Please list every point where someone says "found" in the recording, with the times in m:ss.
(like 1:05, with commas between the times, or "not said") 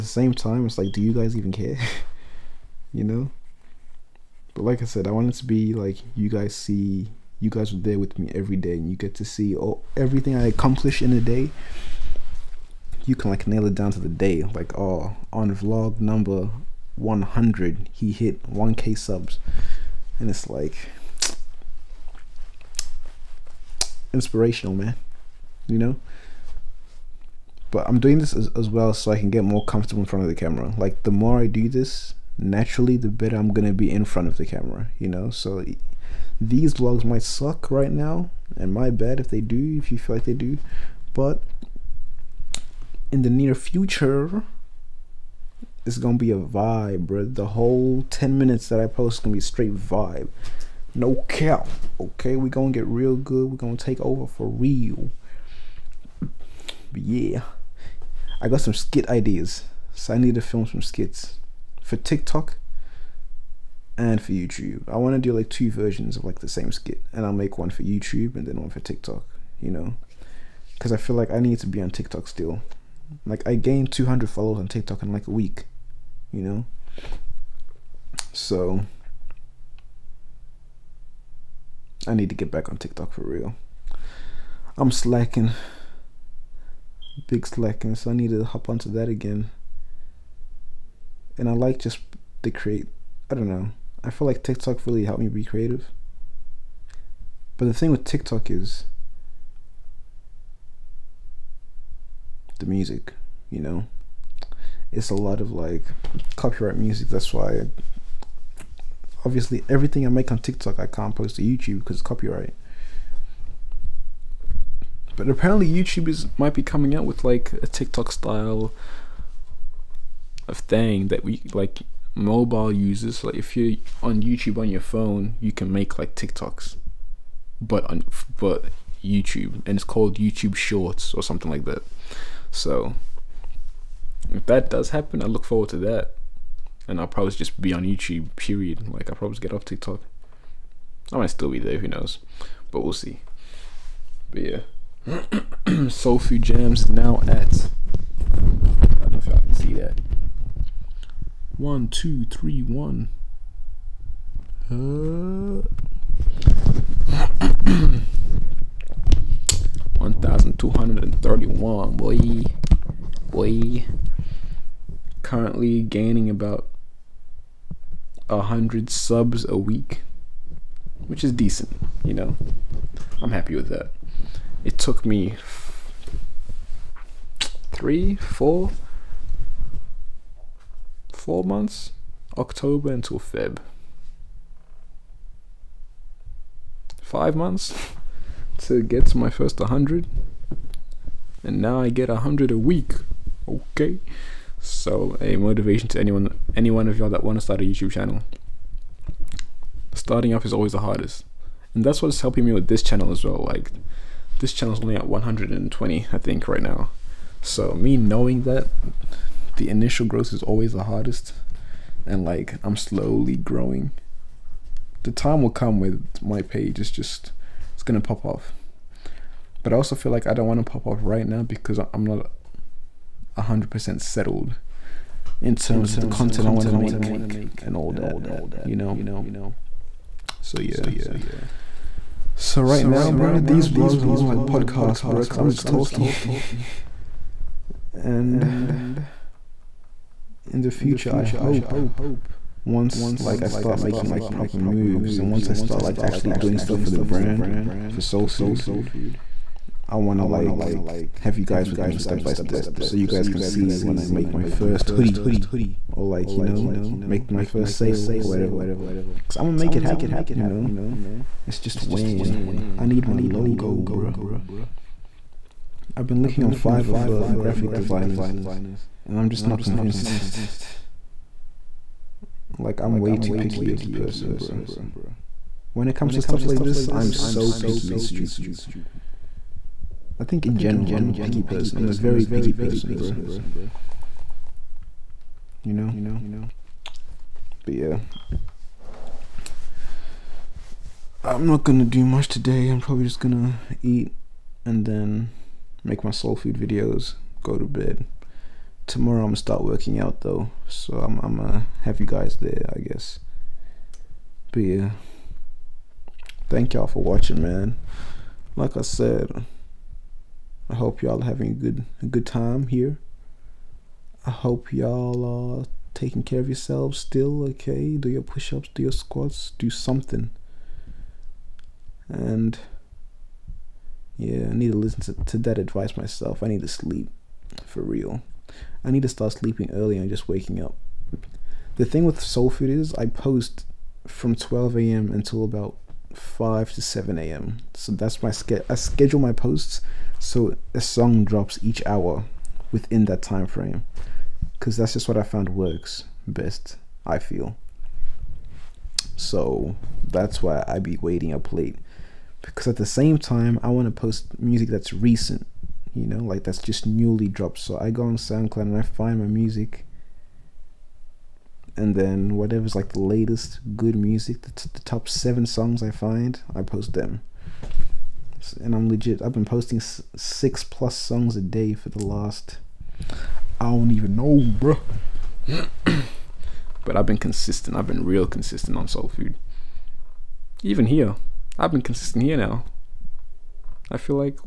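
5:45.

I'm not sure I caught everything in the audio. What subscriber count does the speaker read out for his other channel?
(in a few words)
1,231.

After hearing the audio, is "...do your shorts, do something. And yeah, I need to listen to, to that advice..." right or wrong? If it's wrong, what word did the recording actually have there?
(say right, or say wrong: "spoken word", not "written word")
wrong: "squats", not "shorts".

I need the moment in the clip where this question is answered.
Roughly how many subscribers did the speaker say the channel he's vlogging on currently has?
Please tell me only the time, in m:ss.
3:25.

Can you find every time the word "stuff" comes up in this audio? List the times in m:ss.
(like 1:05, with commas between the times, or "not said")
4:06, 4:36.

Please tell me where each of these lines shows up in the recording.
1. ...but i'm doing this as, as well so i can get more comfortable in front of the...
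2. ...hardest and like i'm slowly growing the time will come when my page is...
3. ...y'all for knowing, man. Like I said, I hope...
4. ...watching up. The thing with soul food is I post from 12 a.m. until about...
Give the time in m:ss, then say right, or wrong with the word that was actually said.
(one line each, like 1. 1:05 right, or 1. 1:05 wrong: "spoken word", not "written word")
1. 0:27 right
2. 3:30 right
3. 5:06 wrong: "watching", not "knowing"
4. 5:30 wrong: "waking", not "watching".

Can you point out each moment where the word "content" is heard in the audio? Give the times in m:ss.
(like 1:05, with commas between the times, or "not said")
3:46.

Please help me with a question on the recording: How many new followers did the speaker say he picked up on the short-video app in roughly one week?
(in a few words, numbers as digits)
200.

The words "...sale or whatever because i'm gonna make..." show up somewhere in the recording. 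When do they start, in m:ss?
4:17.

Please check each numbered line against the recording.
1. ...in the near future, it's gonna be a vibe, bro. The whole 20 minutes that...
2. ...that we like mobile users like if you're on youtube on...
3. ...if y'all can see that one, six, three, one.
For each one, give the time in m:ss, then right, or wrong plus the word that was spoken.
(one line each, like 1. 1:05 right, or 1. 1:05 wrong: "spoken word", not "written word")
1. 0:43 wrong: "10", not "20"
2. 2:01 right
3. 2:29 wrong: "two", not "six".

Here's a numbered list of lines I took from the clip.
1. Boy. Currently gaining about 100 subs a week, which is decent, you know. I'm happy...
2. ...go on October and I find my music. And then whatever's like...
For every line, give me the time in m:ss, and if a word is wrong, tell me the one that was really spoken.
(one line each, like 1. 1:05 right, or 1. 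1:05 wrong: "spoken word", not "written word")
1. 2:43 right
2. 5:57 wrong: "SoundCloud", not "October".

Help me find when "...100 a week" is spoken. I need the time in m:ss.
3:12.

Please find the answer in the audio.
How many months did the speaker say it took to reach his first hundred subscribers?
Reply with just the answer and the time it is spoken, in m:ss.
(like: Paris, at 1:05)
5, at 3:07.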